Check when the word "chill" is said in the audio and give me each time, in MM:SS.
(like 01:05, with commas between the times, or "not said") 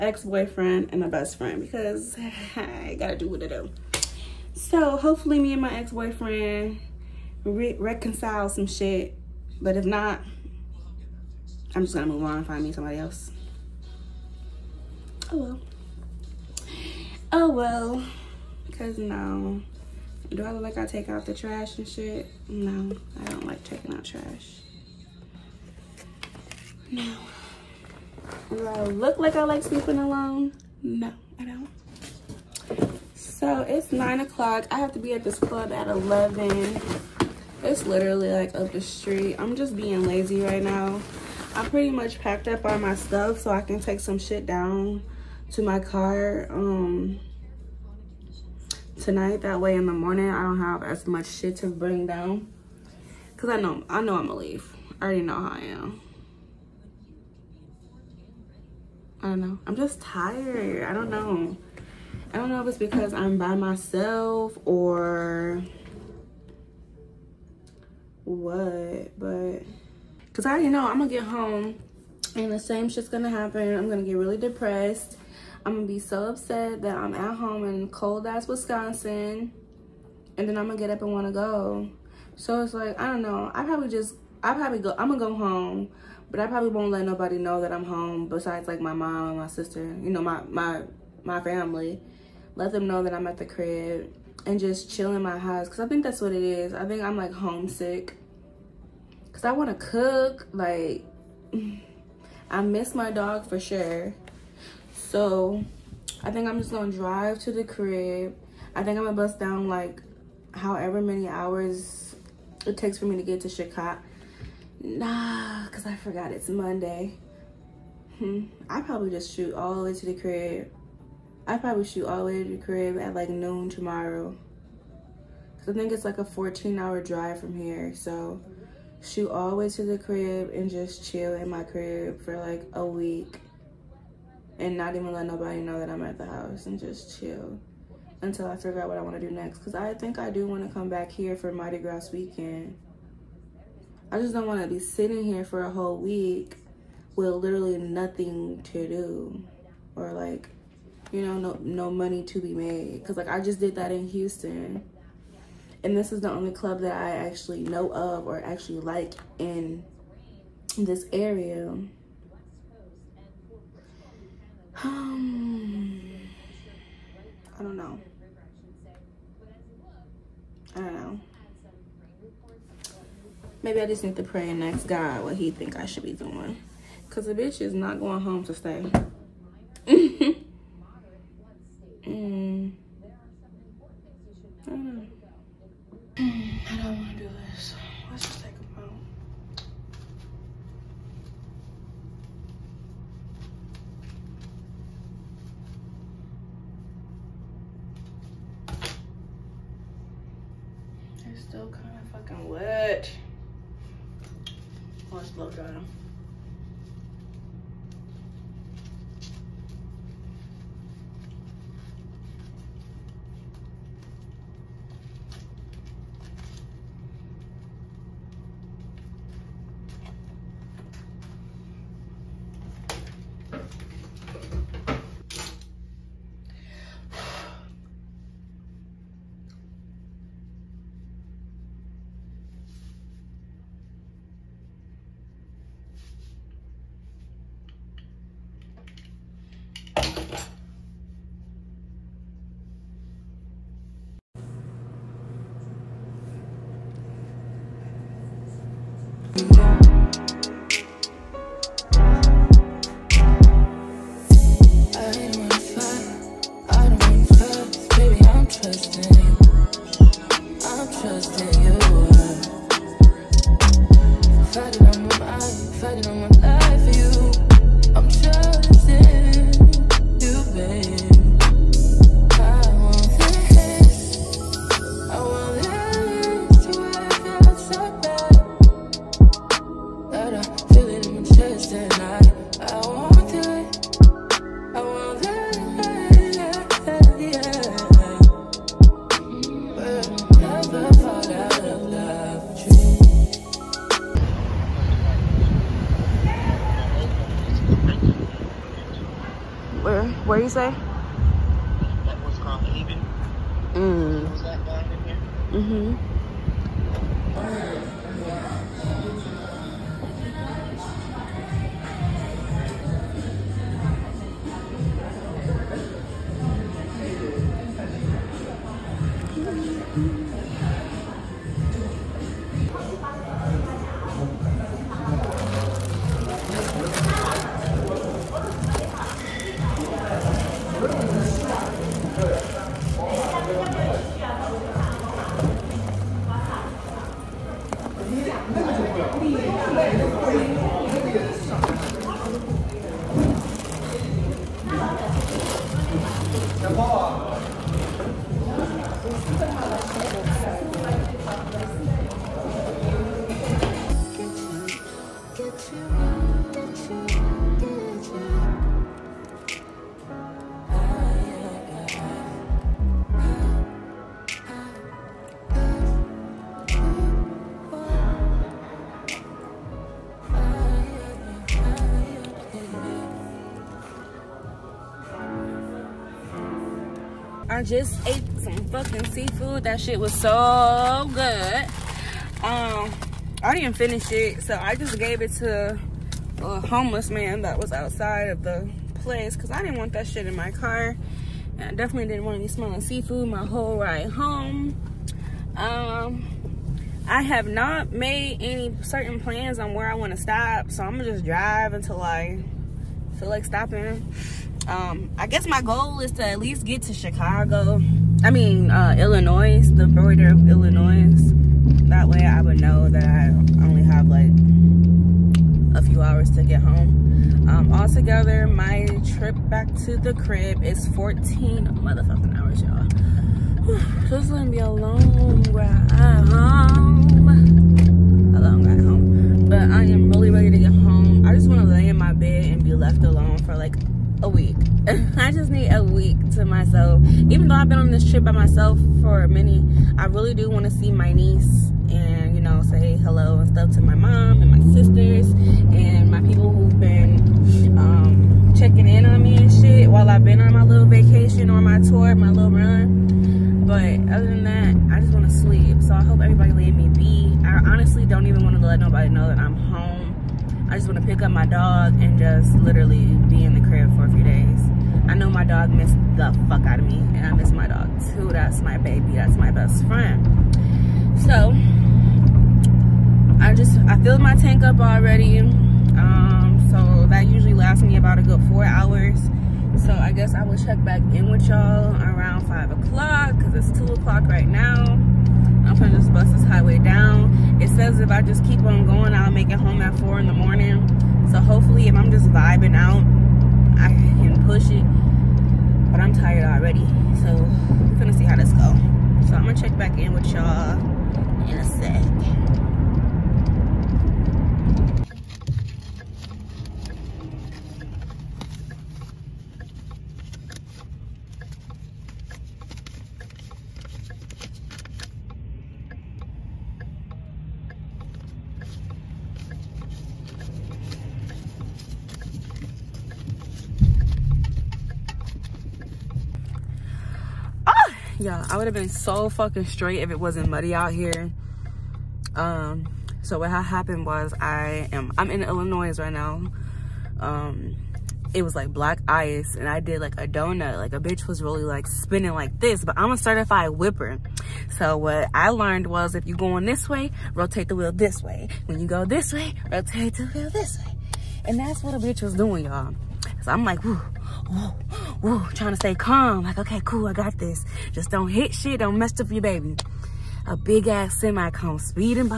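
01:34, 02:11, 02:17.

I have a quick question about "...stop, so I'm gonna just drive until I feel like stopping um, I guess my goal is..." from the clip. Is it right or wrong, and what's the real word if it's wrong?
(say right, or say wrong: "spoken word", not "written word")
right.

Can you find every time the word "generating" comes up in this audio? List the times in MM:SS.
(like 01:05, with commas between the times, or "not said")
not said.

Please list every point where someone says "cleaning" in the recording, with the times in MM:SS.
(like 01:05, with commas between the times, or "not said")
not said.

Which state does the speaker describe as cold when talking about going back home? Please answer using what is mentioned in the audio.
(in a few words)
Wisconsin.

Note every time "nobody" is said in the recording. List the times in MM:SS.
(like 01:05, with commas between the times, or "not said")
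01:27, 02:15, 07:38.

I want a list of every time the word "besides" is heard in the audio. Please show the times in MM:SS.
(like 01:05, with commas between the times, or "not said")
01:28.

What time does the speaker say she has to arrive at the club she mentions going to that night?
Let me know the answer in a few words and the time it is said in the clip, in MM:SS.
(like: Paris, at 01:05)
11, at 00:35.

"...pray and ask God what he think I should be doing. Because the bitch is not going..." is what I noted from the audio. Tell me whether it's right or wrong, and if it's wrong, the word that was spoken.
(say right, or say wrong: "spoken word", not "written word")
right.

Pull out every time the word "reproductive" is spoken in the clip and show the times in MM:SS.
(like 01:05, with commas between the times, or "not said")
not said.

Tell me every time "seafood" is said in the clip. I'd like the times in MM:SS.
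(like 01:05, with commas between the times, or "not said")
06:19, 06:32.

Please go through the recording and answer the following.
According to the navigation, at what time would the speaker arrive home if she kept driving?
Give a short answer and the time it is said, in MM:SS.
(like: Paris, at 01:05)
4 in the morning, at 08:09.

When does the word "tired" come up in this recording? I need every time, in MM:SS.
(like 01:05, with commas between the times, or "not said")
00:59, 08:16.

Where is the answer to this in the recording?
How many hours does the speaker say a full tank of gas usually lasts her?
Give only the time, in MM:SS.
07:58.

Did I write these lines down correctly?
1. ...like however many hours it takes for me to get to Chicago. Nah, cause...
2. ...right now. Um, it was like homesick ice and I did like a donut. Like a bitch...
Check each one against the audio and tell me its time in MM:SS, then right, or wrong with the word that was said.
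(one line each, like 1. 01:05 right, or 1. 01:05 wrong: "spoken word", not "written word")
1. 01:49 right
2. 08:55 wrong: "black", not "homesick".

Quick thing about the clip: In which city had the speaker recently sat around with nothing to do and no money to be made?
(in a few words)
Houston.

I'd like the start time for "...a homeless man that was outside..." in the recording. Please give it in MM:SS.
06:26.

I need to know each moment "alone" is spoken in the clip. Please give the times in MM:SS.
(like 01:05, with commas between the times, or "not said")
00:29, 07:13.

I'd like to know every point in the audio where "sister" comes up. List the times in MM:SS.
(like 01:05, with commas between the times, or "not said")
01:29, 07:24.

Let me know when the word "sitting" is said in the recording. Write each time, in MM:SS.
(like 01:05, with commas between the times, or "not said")
02:24.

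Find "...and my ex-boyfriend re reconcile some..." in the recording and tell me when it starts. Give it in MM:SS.
00:05.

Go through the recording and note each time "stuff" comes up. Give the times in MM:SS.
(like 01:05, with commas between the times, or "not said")
00:42, 07:23.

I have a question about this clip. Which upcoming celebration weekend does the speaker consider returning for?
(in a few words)
Mardi Gras.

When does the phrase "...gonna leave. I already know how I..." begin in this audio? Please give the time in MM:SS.
00:54.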